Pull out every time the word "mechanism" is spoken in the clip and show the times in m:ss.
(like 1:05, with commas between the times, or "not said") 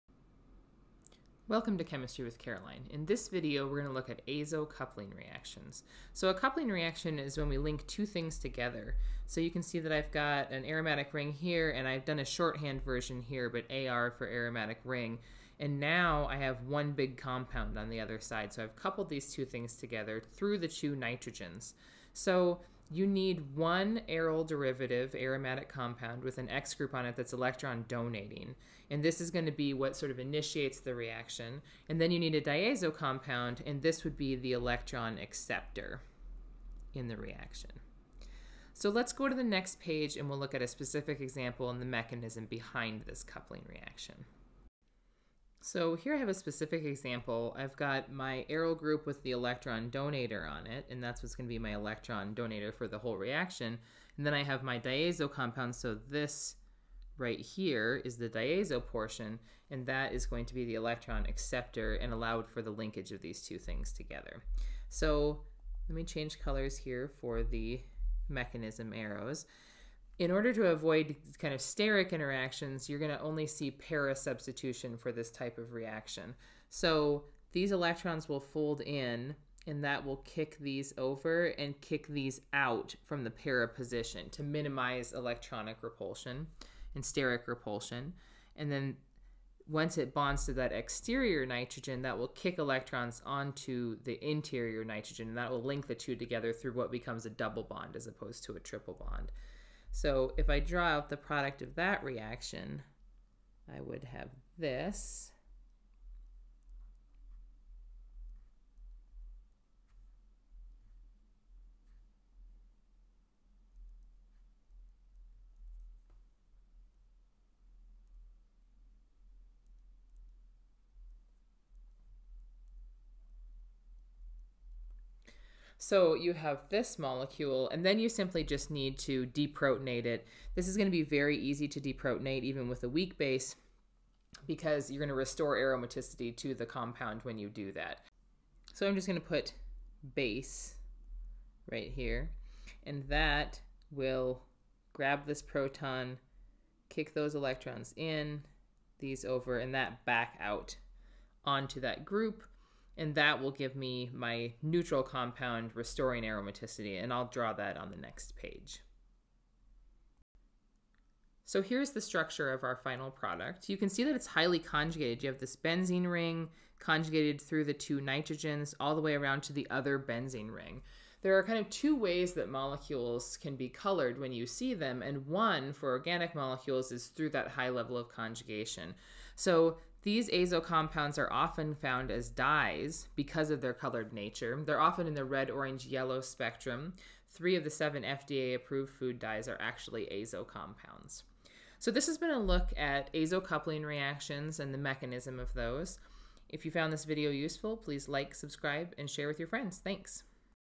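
0:41, 1:08, 3:14.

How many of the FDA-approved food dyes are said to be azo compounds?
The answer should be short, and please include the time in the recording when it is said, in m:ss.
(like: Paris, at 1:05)
3, at 3:07.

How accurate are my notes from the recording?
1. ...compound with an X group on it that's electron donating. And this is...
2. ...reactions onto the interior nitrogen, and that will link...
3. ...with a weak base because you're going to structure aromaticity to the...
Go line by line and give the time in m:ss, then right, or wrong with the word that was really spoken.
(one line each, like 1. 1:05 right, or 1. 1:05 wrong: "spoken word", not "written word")
1. 0:25 right
2. 1:32 wrong: "electrons", not "reactions"
3. 2:12 wrong: "restore", not "structure".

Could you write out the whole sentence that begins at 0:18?
So I've coupled these two things together through the two nitrogens.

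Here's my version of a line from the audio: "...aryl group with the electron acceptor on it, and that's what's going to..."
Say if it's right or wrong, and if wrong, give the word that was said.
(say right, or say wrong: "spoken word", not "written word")
wrong: "donator", not "acceptor".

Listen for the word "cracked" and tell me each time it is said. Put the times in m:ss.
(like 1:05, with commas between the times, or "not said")
not said.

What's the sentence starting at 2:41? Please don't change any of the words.
So here's the structure of our final product.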